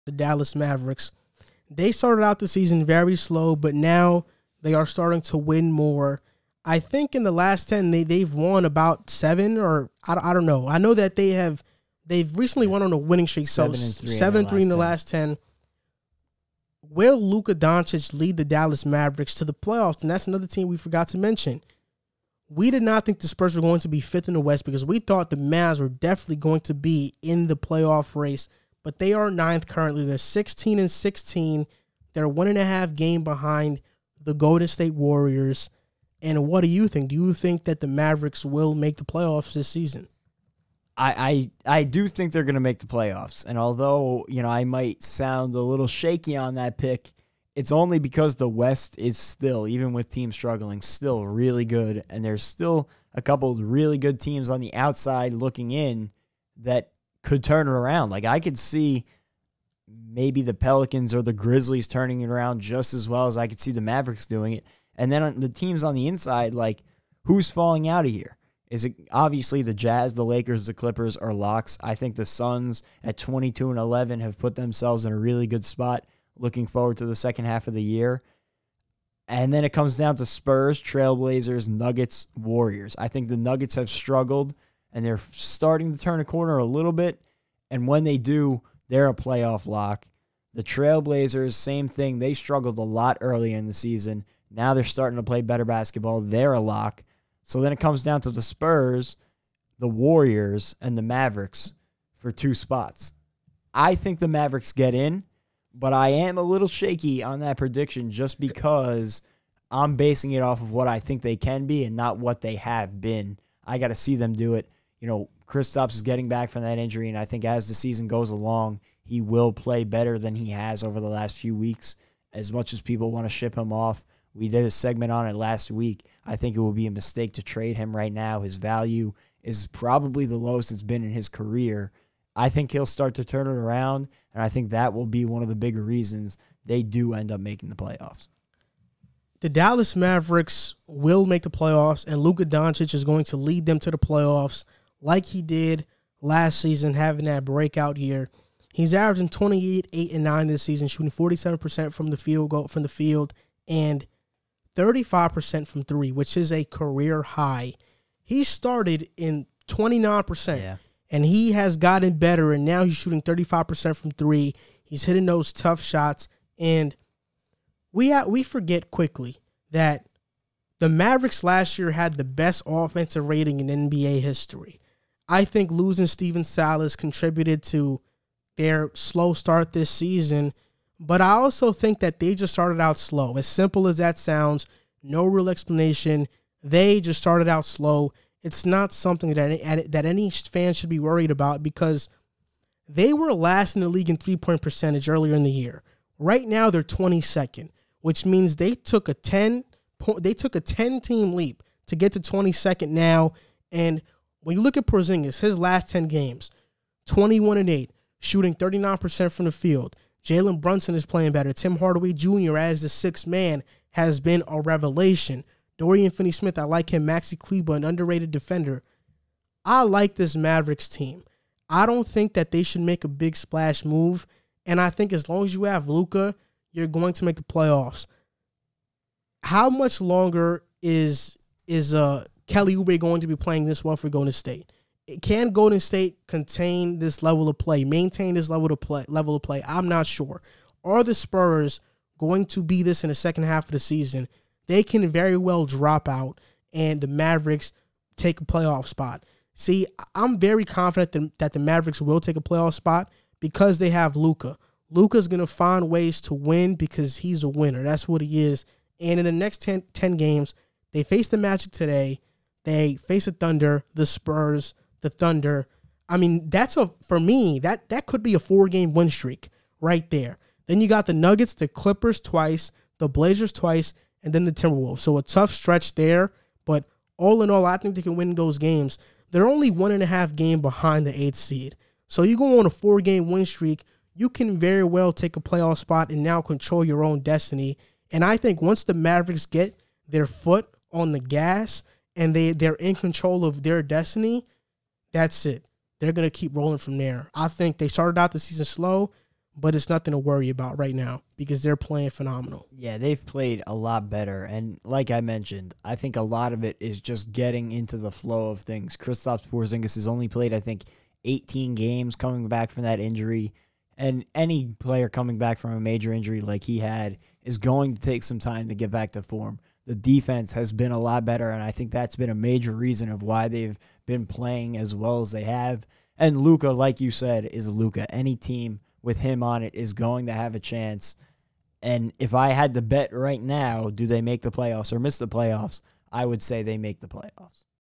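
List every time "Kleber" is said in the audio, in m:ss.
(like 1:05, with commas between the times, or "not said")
3:37.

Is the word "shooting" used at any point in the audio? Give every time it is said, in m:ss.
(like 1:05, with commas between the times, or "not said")
2:30, 2:42, 3:28.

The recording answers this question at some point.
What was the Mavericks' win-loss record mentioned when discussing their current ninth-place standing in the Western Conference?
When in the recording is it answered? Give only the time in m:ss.
0:30.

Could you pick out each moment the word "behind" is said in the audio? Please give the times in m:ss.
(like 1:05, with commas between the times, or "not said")
0:33, 4:40.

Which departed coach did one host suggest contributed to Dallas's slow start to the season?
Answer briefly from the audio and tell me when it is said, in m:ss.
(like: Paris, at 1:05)
Stephen Silas, at 2:56.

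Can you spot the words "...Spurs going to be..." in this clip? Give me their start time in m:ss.
4:01.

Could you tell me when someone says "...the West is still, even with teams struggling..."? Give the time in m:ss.
0:48.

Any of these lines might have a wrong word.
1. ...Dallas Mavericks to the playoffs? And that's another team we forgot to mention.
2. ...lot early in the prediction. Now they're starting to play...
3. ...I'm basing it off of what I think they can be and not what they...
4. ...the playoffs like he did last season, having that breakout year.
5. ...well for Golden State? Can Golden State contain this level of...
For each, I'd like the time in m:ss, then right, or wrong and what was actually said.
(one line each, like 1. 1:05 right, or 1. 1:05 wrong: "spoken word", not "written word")
1. 0:18 right
2. 1:32 wrong: "season", not "prediction"
3. 1:49 right
4. 2:23 right
5. 3:53 right.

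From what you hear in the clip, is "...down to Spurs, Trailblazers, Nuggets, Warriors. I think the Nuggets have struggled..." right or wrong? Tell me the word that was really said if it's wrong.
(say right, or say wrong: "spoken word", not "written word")
right.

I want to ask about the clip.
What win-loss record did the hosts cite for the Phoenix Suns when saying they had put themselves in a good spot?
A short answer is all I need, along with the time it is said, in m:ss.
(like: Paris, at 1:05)
22 and 11, at 1:13.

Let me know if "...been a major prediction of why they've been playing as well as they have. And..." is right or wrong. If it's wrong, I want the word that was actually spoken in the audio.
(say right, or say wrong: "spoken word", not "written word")
wrong: "reason", not "prediction".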